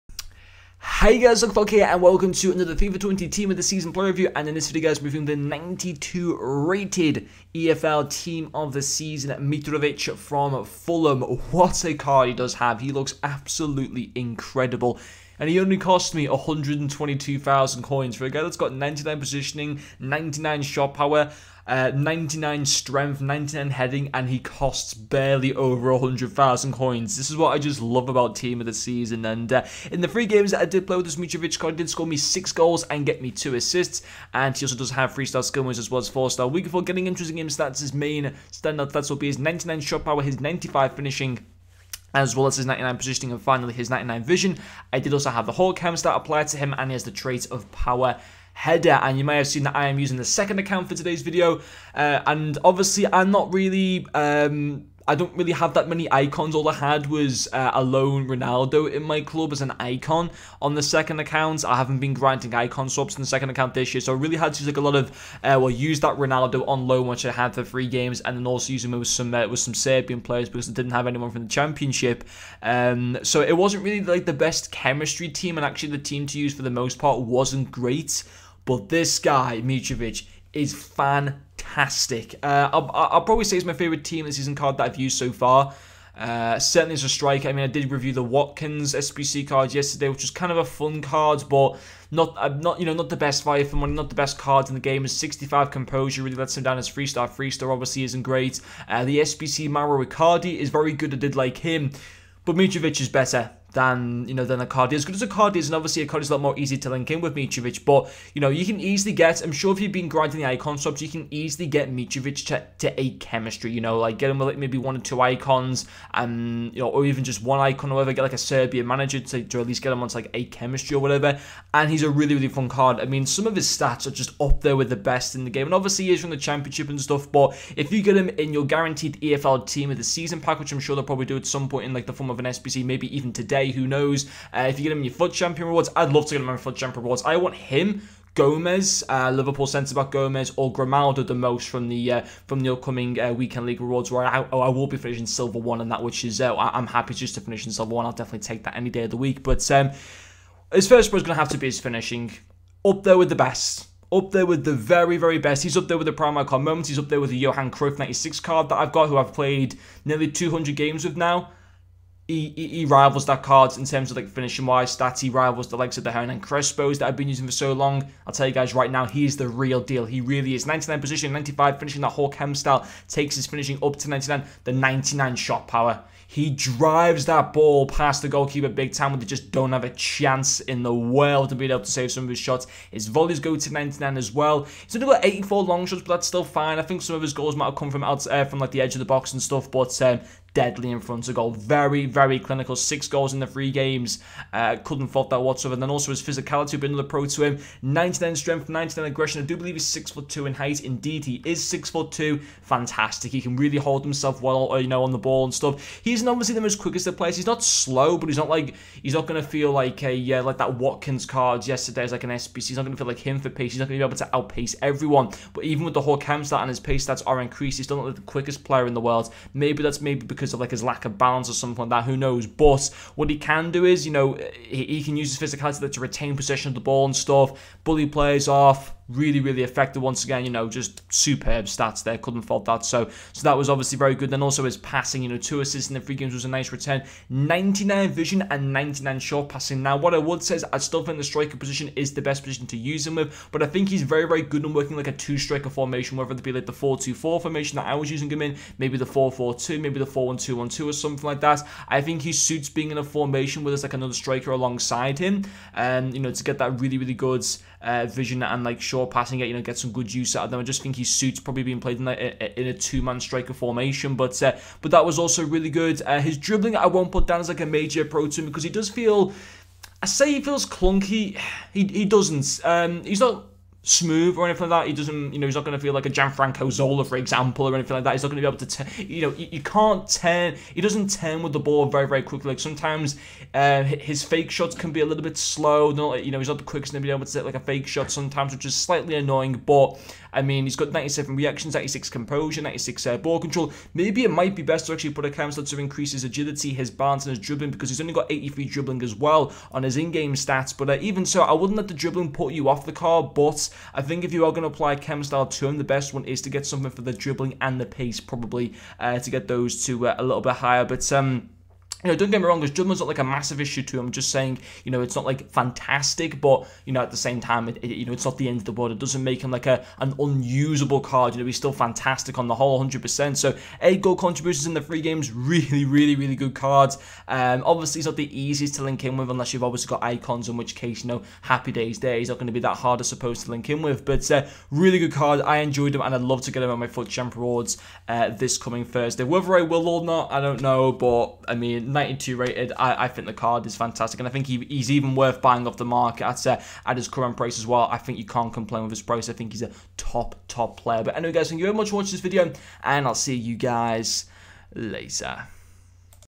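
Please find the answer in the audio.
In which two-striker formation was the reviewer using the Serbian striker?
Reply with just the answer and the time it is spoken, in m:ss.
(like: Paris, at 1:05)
4-2-4, at 4:06.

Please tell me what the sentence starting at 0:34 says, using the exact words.
And he also does have three star skill moves as well as four star.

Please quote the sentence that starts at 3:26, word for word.
He's obviously the most quickest of players.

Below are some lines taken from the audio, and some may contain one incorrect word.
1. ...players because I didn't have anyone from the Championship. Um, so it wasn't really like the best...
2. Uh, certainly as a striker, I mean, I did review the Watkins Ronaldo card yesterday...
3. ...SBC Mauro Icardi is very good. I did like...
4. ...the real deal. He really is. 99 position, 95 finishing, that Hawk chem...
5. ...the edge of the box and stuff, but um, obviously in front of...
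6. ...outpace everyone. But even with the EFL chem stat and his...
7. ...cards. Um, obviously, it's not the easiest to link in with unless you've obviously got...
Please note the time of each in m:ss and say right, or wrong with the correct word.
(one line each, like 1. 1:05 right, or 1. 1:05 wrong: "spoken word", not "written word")
1. 1:10 right
2. 1:26 wrong: "SBC", not "Ronaldo"
3. 1:39 right
4. 2:49 right
5. 3:08 wrong: "deadly", not "obviously"
6. 3:34 wrong: "Hawk", not "EFL"
7. 5:26 right.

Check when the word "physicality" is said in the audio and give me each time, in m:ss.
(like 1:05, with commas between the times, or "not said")
3:16, 3:45.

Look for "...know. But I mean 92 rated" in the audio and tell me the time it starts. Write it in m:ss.
5:40.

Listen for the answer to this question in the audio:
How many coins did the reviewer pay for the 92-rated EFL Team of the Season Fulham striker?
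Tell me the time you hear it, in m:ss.
0:16.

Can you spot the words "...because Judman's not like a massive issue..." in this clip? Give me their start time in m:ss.
5:12.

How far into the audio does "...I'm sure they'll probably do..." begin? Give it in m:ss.
2:10.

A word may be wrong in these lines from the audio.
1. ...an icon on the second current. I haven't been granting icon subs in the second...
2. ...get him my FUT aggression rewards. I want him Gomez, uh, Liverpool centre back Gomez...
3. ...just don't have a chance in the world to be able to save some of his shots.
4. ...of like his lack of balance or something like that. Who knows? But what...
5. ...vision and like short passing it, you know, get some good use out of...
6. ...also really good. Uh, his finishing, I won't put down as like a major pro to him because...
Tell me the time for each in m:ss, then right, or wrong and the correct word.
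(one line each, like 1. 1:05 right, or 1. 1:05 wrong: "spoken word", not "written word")
1. 0:59 wrong: "account", not "current"
2. 2:16 wrong: "champion", not "aggression"
3. 2:59 right
4. 3:40 right
5. 4:18 right
6. 4:25 wrong: "dribbling", not "finishing".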